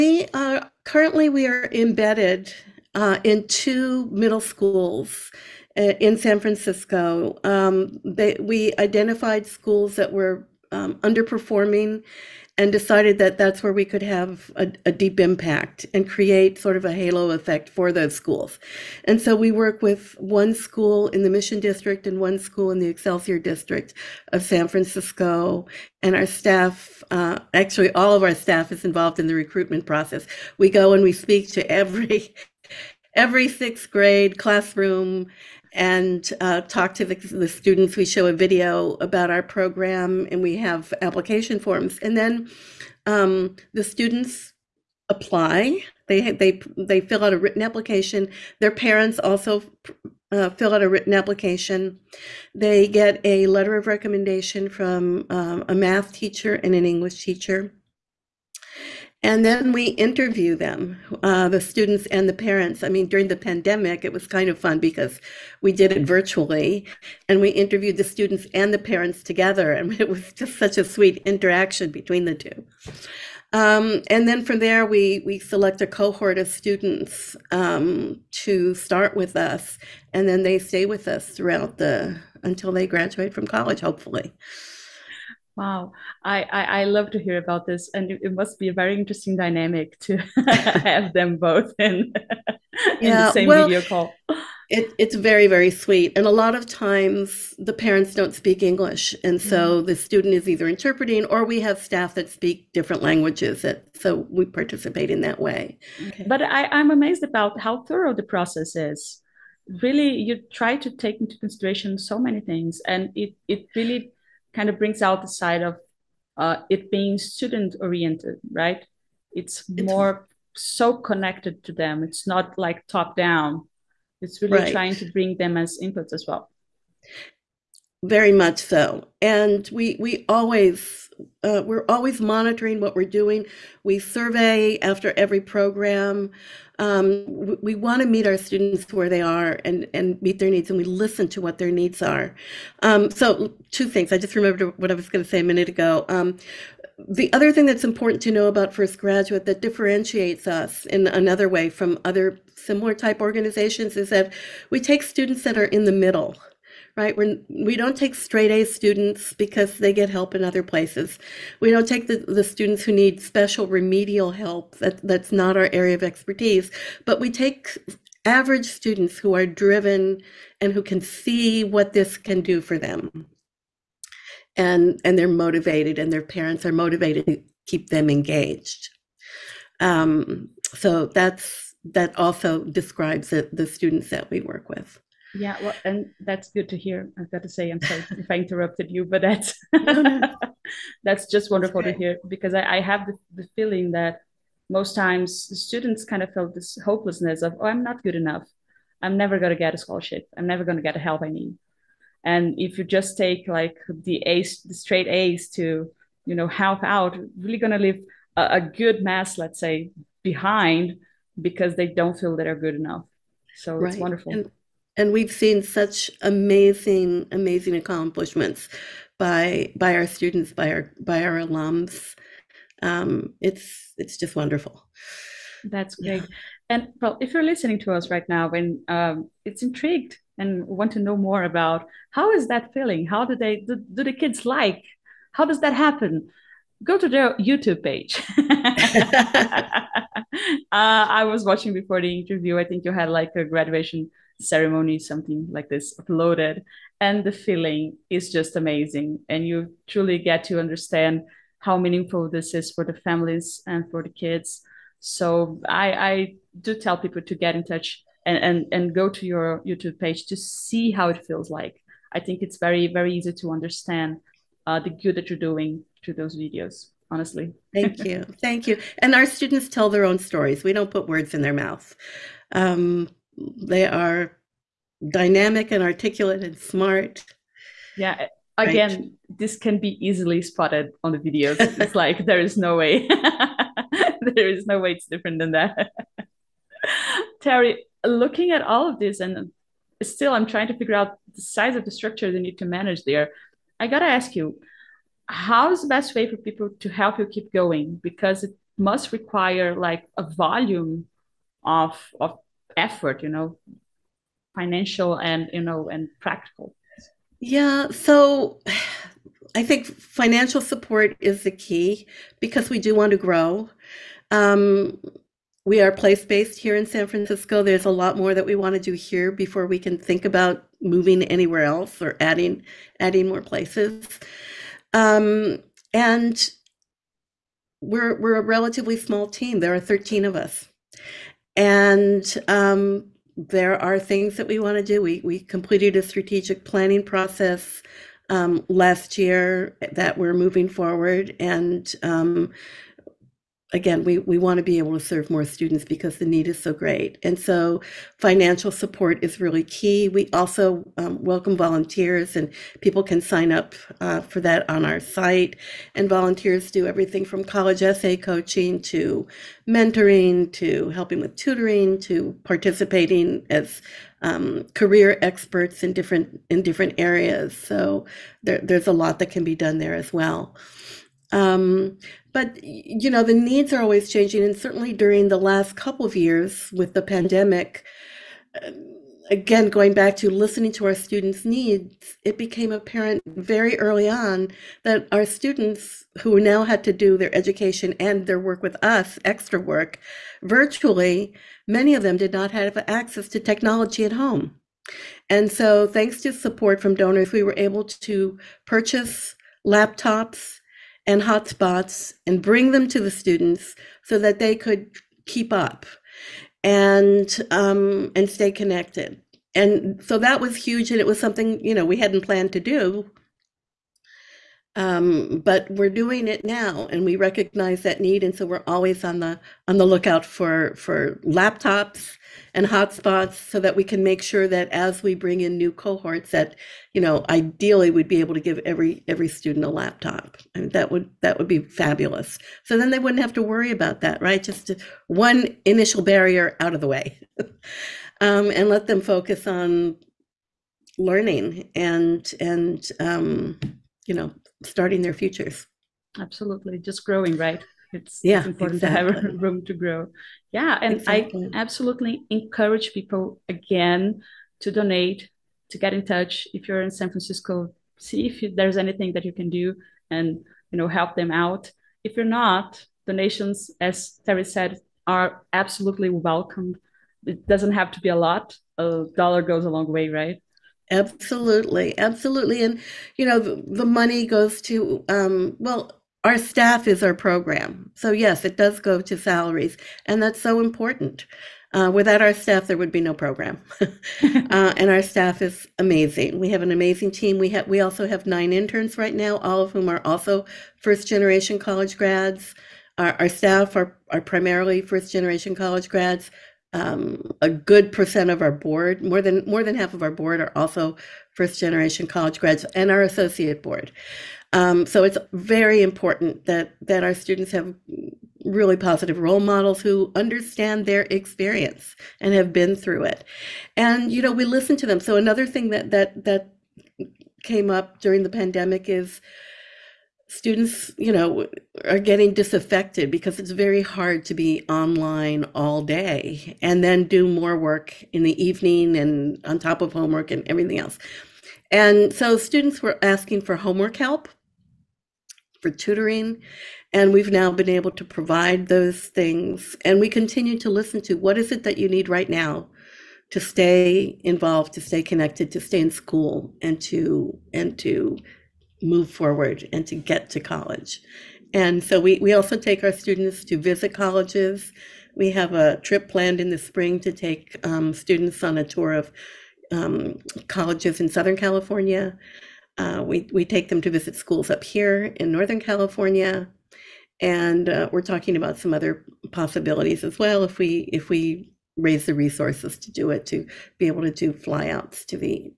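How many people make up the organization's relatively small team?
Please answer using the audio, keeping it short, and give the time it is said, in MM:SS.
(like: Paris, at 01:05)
13, at 05:29.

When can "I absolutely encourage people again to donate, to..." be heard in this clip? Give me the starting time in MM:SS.
07:31.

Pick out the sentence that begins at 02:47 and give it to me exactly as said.
But we take average students who are driven and who can see what this can do for them.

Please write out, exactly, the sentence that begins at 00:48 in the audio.
Their parents also uh, fill out a written application.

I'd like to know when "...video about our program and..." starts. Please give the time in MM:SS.
00:38.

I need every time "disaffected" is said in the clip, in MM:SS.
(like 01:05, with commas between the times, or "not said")
08:42.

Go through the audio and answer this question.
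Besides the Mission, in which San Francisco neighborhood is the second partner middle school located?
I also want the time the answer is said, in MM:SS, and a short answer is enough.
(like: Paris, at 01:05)
Excelsior District, at 00:22.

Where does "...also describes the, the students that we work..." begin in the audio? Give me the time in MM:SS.
03:02.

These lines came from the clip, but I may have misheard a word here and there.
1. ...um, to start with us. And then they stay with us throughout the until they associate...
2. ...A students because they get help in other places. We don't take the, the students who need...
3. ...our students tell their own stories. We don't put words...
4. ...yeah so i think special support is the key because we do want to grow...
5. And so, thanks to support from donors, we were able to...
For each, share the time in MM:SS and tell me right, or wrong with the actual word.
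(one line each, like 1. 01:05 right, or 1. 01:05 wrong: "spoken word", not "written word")
1. 01:17 wrong: "graduate", not "associate"
2. 02:38 right
3. 04:29 right
4. 05:07 wrong: "financial", not "special"
5. 06:35 right.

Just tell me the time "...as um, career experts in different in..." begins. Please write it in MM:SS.
06:03.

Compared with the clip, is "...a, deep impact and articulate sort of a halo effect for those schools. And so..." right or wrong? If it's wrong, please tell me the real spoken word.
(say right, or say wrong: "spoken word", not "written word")
wrong: "create", not "articulate".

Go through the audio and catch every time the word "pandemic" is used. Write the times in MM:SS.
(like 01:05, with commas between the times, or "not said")
01:03, 06:17, 08:38.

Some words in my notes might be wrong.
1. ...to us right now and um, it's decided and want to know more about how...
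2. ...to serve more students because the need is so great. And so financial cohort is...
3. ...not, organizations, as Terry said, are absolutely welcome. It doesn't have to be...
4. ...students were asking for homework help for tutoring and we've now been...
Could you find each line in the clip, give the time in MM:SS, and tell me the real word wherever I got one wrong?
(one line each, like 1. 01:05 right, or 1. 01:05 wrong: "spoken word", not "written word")
1. 03:47 wrong: "intrigued", not "decided"
2. 05:44 wrong: "support", not "cohort"
3. 07:42 wrong: "donations", not "organizations"
4. 08:52 right.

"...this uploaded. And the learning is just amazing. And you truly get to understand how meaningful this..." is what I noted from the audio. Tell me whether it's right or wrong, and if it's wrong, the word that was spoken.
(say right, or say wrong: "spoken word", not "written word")
wrong: "feeling", not "learning".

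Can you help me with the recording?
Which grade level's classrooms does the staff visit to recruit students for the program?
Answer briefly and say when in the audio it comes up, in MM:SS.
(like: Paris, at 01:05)
Sixth grade, at 00:33.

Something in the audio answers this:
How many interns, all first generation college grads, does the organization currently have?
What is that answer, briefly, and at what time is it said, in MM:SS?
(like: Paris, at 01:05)
9, at 08:08.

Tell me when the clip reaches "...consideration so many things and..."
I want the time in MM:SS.
01:51.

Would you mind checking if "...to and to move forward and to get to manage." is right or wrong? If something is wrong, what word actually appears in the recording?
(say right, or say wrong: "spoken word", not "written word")
wrong: "college", not "manage".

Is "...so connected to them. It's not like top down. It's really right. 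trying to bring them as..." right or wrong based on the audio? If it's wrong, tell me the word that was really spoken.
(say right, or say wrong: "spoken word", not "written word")
right.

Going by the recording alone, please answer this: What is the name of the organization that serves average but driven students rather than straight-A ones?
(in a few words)
First Graduate.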